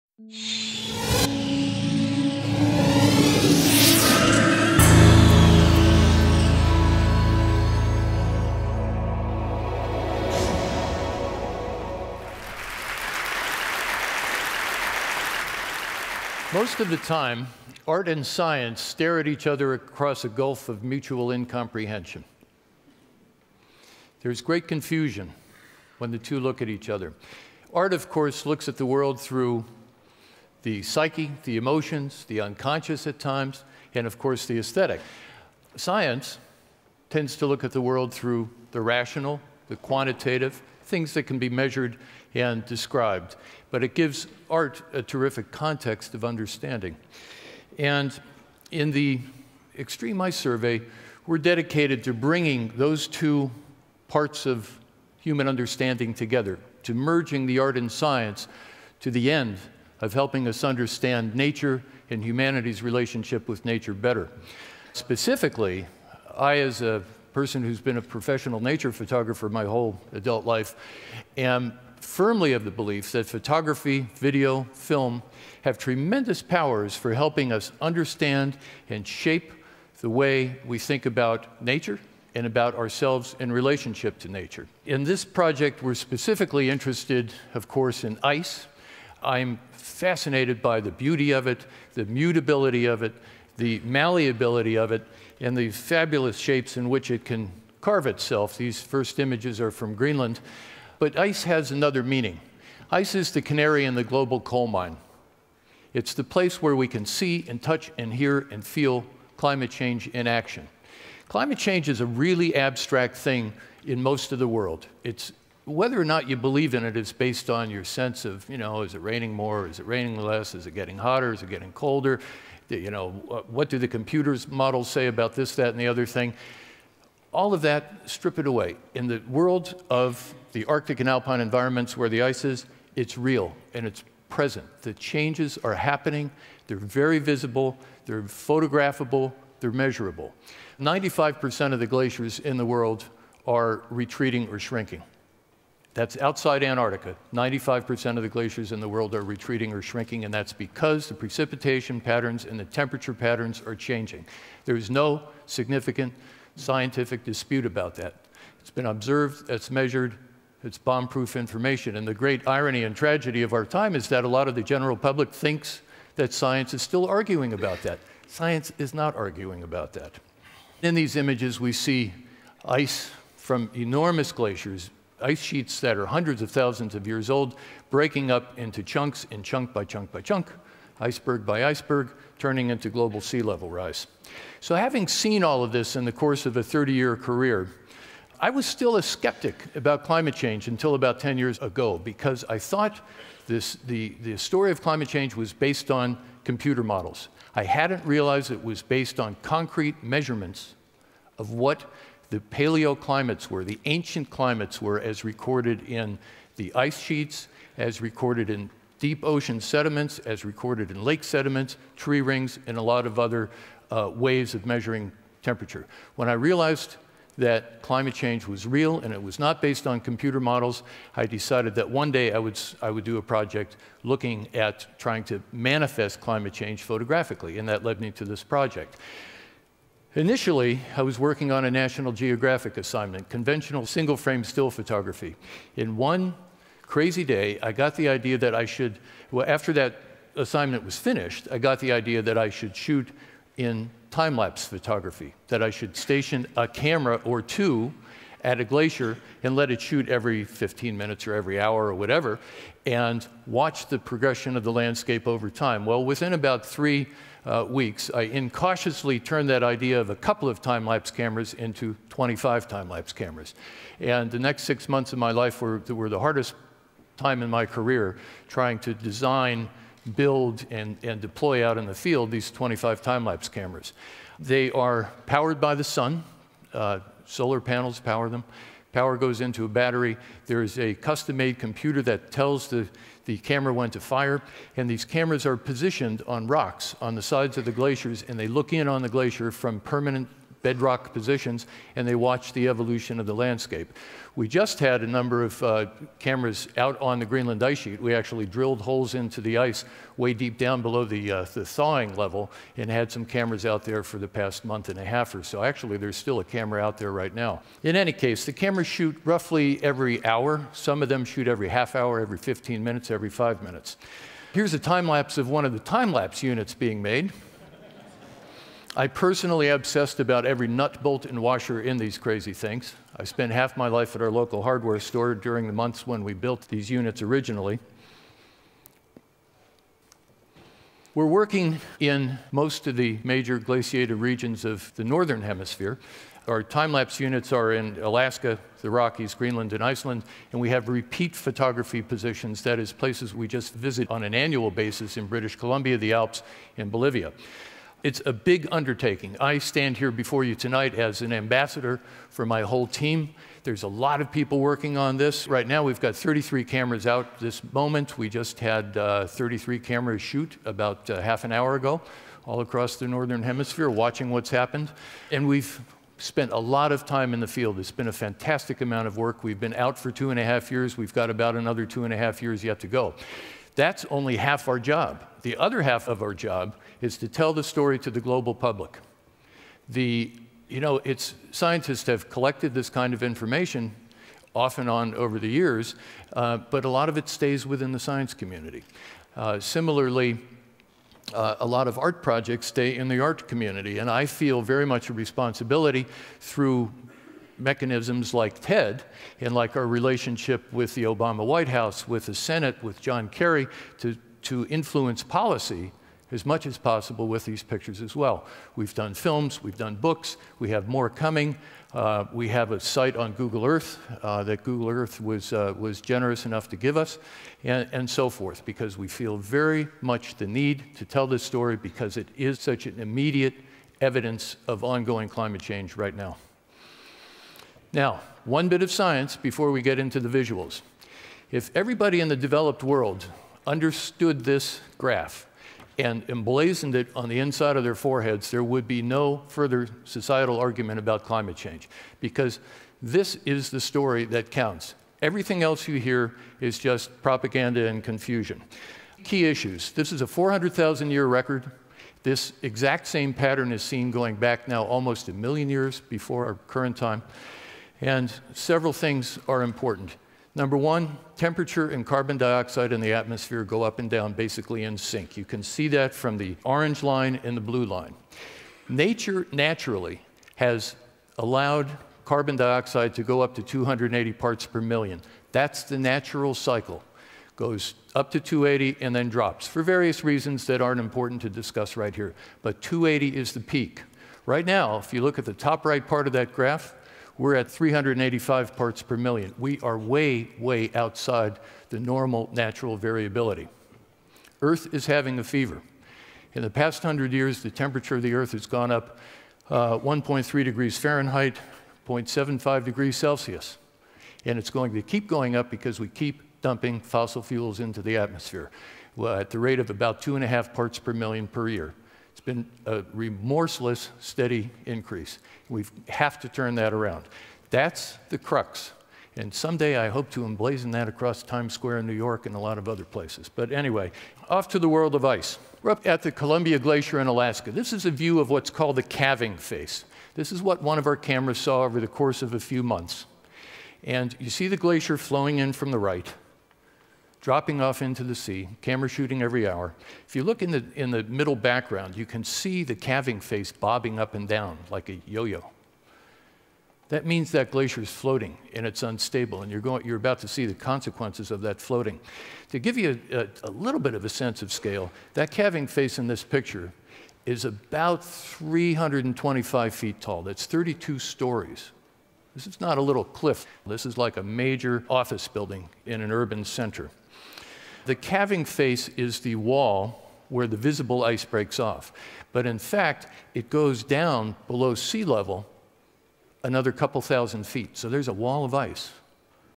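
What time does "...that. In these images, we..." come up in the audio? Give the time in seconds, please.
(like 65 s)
169 s.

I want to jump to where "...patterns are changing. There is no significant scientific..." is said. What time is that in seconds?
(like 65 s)
153 s.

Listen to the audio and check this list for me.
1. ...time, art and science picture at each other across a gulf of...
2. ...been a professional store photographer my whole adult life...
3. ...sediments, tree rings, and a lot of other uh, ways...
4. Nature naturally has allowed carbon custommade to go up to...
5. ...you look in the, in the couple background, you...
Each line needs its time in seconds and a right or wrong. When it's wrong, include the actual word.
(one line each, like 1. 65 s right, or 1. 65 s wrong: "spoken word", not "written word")
1. 17 s wrong: "stare", not "picture"
2. 67 s wrong: "nature", not "store"
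3. 211 s right
4. 468 s wrong: "dioxide", not "custommade"
5. 540 s wrong: "middle", not "couple".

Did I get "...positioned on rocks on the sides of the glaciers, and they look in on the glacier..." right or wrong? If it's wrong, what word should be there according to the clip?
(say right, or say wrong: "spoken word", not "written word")
right.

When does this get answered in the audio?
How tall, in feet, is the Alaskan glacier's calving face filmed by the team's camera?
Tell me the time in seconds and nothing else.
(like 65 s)
558 s.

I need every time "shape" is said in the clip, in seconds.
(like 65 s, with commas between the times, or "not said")
79 s, 96 s.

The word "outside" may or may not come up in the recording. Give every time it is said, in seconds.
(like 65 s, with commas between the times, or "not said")
146 s, 490 s.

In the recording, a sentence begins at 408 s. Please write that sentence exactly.
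We've done films, we've done books, we have more coming.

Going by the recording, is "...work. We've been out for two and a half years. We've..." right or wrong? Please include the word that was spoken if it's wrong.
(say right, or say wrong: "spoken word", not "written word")
right.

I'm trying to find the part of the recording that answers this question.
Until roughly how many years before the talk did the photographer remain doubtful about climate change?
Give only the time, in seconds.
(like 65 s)
190 s.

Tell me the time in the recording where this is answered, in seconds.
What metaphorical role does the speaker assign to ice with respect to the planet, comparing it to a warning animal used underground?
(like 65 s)
103 s.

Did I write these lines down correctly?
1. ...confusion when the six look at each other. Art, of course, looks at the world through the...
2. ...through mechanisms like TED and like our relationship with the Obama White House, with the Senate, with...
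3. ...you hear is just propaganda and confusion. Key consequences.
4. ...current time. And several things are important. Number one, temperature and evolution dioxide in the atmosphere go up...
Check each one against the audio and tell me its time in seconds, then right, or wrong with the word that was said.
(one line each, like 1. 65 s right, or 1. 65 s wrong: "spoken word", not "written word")
1. 24 s wrong: "two", not "six"
2. 396 s right
3. 445 s wrong: "issues", not "consequences"
4. 456 s wrong: "carbon", not "evolution".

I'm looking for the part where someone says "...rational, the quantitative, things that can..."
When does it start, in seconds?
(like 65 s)
38 s.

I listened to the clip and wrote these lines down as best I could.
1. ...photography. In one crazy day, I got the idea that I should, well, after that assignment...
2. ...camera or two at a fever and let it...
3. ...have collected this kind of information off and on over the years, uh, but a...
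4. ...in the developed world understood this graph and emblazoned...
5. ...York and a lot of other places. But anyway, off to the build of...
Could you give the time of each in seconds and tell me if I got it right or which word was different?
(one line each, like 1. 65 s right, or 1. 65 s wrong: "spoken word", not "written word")
1. 234 s right
2. 246 s wrong: "glacier", not "fever"
3. 382 s right
4. 432 s right
5. 522 s wrong: "world", not "build".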